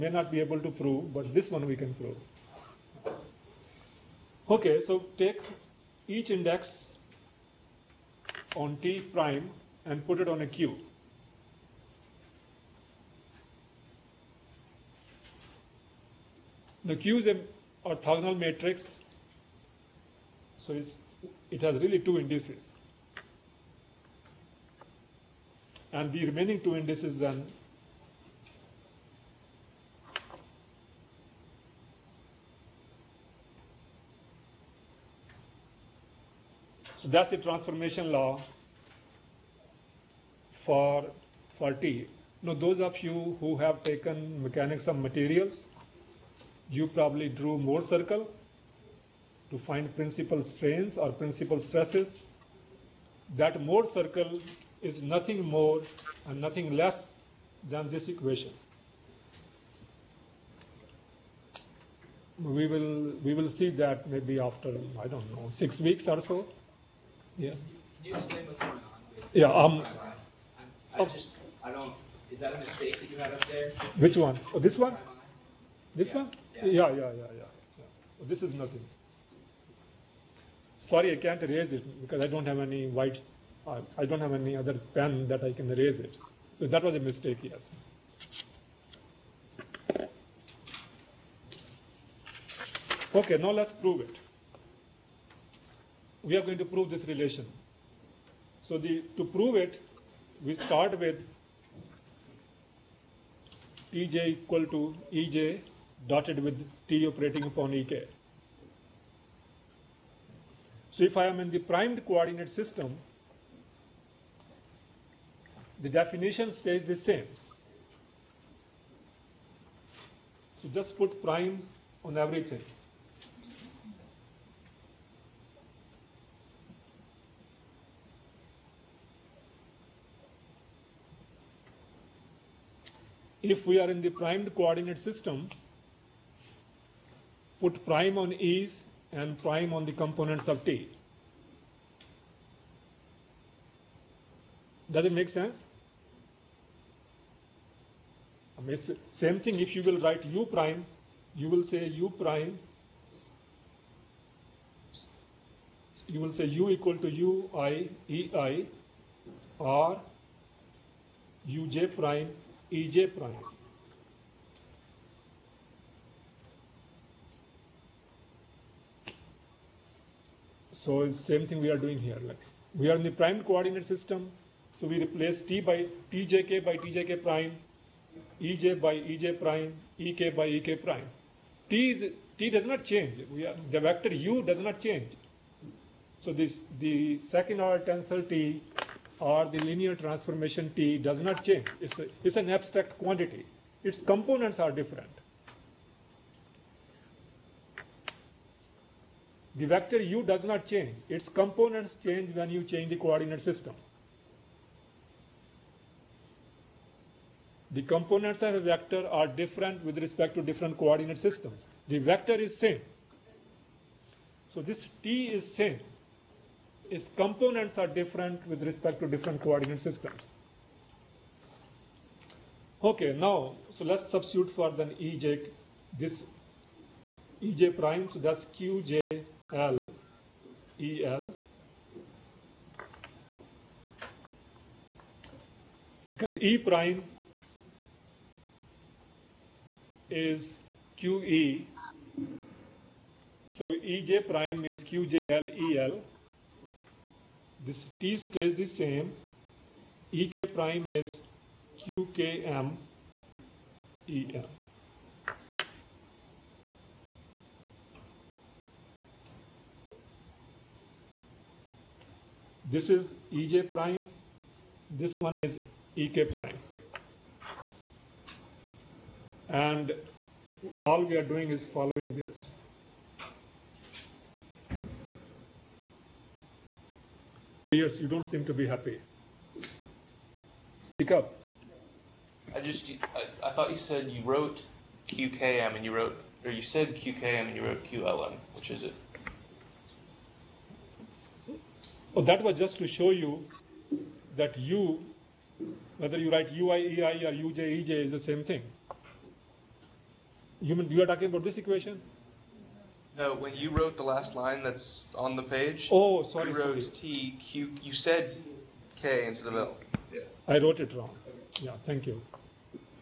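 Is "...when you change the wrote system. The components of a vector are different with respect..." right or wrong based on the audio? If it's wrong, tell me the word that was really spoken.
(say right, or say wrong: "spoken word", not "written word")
wrong: "coordinate", not "wrote".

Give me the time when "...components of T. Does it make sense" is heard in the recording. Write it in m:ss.
2:20.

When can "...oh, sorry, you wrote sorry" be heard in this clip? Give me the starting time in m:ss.
5:05.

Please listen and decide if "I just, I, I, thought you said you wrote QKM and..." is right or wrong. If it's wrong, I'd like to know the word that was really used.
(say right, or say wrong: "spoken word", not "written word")
right.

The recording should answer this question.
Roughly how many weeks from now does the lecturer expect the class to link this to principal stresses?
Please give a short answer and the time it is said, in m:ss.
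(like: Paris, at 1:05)
6, at 1:05.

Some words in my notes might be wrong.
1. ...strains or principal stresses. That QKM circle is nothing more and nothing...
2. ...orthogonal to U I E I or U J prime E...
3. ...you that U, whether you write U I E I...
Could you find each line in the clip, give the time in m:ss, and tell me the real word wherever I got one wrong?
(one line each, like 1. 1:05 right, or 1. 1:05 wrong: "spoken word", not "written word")
1. 0:50 wrong: "Mohr", not "QKM"
2. 2:36 wrong: "equal", not "orthogonal"
3. 4:53 right.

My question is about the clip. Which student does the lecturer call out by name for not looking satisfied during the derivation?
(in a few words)
Pierce.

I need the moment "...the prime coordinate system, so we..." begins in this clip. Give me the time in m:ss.
2:53.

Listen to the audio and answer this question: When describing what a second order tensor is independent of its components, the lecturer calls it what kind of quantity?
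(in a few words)
abstract quantity.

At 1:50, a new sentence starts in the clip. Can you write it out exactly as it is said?
So if I am in the primed coordinate system, the definition stays the same.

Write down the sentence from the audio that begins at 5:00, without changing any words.
You, mean, you are talking about this equation?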